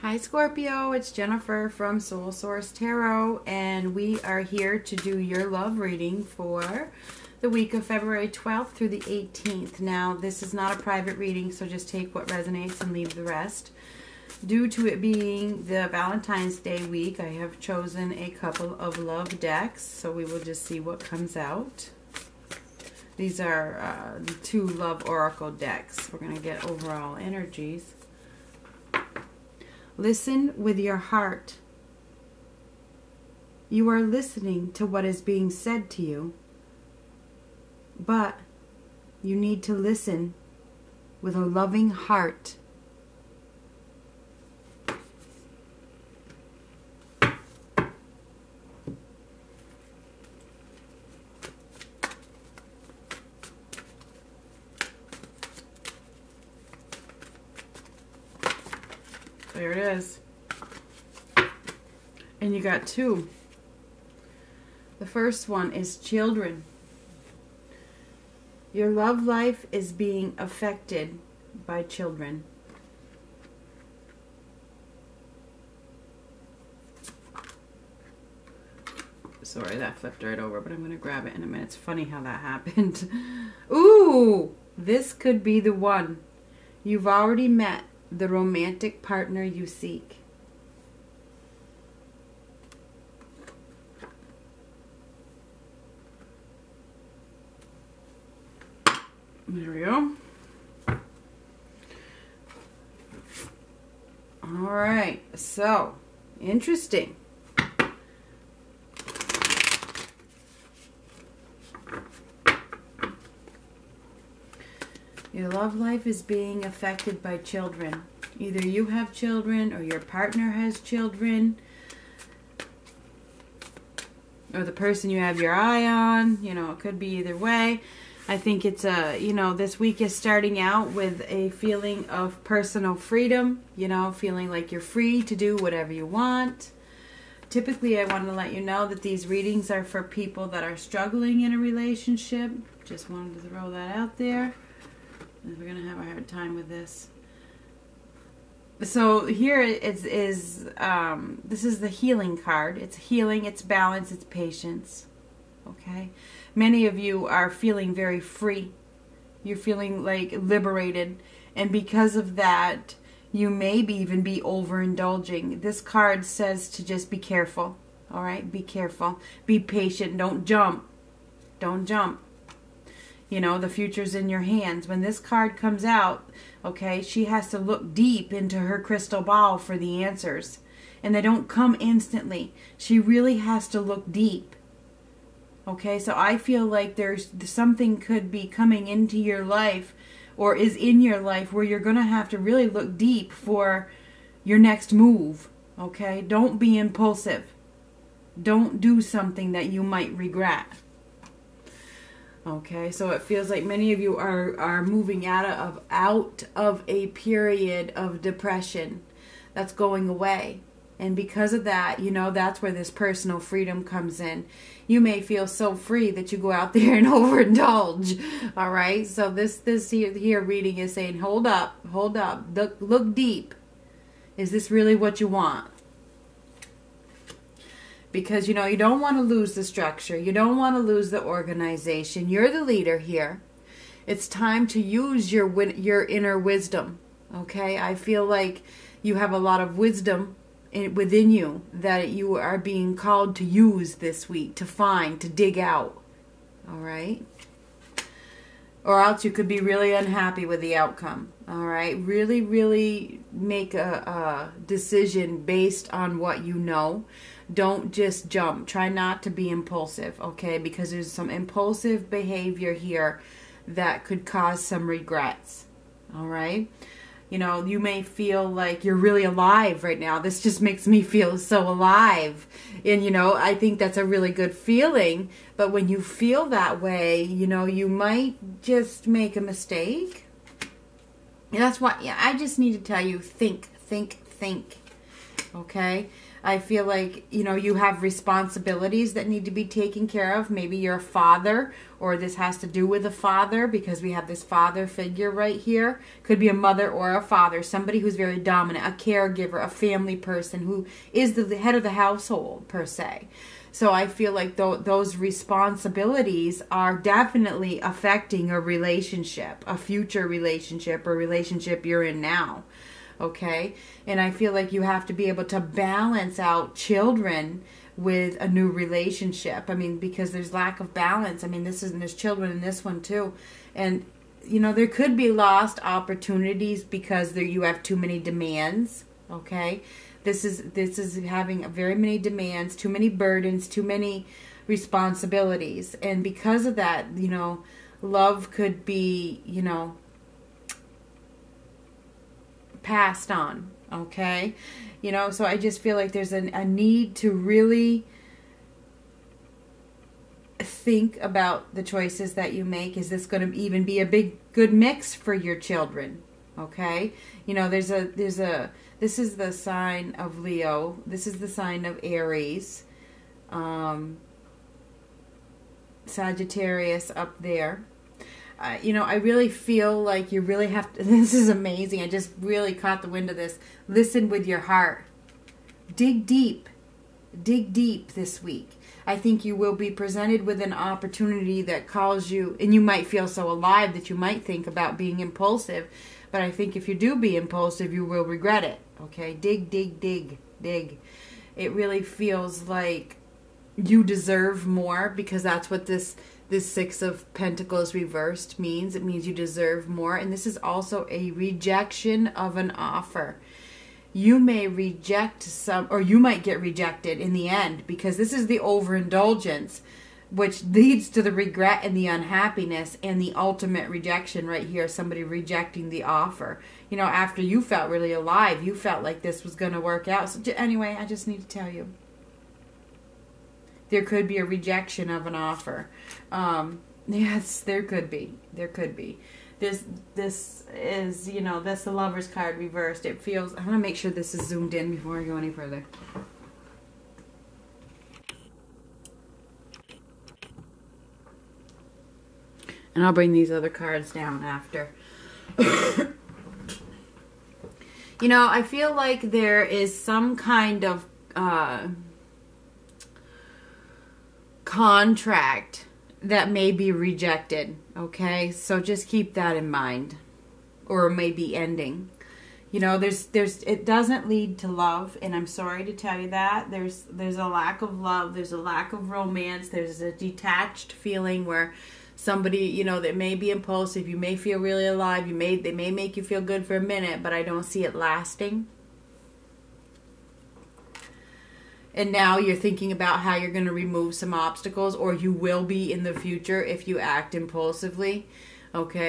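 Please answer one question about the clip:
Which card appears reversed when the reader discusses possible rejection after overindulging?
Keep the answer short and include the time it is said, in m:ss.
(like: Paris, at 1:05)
The Lovers, at 7:11.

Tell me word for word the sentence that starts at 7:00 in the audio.
So, anyway, I just need to tell you there could be a rejection of an offer.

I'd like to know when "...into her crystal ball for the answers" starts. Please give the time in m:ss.
2:58.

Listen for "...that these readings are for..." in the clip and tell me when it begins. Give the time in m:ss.
2:18.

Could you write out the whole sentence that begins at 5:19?
I mean, because there's lack of balance.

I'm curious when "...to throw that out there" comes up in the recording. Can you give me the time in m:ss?
2:23.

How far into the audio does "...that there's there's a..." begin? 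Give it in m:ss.
7:46.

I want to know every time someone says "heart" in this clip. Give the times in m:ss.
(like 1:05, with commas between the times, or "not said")
0:30, 0:41, 6:14.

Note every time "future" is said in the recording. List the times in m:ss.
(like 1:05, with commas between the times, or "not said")
2:53, 5:09, 8:06.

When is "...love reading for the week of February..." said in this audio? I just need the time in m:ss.
0:05.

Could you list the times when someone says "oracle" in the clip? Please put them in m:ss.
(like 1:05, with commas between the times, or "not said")
0:25.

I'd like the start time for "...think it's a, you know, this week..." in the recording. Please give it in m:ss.
2:08.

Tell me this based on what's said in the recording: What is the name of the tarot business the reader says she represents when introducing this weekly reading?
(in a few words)
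Soul Source Tarot.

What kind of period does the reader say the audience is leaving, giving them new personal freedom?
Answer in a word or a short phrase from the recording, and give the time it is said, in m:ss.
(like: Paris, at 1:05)
A period of depression, at 3:26.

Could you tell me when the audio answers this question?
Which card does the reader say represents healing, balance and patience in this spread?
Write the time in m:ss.
2:31.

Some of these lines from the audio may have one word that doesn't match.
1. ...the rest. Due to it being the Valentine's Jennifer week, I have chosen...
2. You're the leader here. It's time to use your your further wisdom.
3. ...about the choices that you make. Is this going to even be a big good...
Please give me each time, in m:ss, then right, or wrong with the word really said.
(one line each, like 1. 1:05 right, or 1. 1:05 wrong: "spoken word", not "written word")
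1. 0:13 wrong: "Day", not "Jennifer"
2. 3:52 wrong: "inner", not "further"
3. 5:51 right.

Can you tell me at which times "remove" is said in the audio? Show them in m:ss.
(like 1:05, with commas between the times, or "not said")
8:03.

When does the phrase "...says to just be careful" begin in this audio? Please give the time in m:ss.
2:46.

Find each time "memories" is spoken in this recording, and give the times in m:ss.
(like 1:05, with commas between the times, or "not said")
not said.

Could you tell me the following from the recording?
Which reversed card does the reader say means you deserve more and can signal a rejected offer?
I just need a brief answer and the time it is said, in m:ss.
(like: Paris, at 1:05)
Six of Pentacles, at 6:36.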